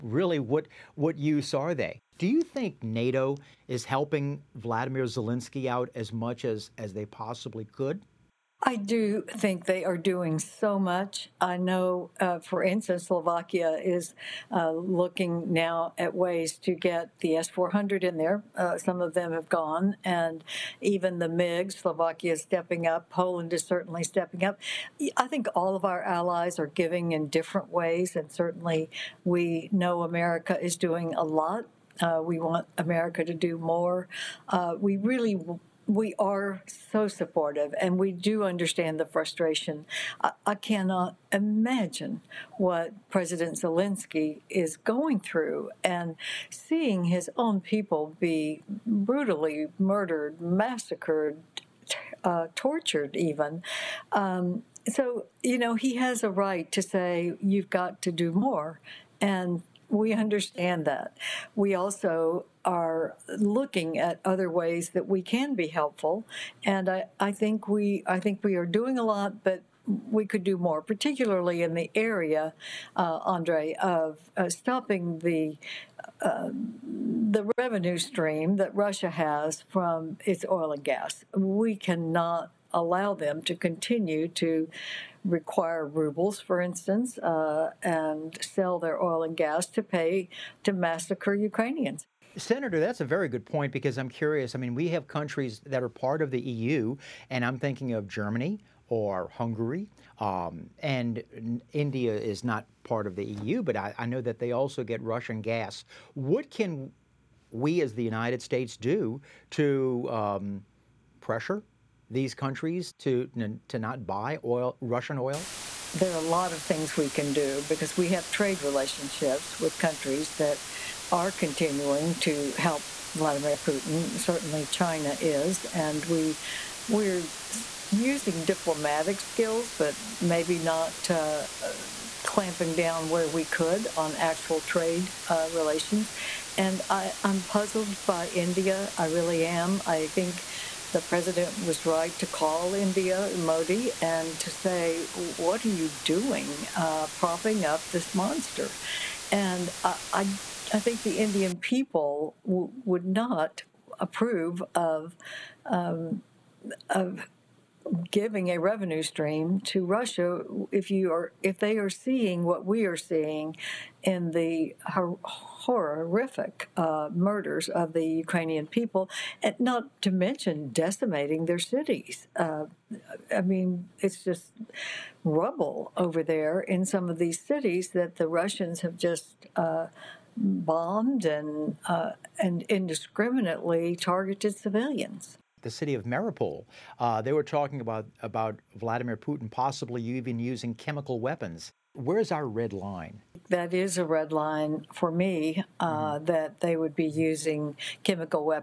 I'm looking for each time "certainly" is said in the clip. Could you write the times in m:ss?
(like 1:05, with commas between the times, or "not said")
0:23, 0:28, 2:04.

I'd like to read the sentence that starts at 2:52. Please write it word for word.
Uh, I mean, it's just rubble over there in some of these cities that the Russians have just.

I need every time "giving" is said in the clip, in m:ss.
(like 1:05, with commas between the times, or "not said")
0:26, 2:38.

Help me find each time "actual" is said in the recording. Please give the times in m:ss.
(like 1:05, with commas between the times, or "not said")
2:14.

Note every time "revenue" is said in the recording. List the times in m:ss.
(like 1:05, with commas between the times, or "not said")
1:17, 2:38.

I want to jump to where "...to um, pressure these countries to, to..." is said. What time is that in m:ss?
1:49.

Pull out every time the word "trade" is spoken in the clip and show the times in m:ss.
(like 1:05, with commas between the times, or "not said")
1:58, 2:14.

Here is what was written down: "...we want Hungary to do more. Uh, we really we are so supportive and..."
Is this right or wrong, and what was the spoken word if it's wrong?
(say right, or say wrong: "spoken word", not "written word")
wrong: "America", not "Hungary".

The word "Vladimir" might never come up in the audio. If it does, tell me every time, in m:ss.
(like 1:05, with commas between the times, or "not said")
0:04, 2:03, 3:08.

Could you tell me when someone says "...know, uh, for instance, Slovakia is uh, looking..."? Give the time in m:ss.
0:11.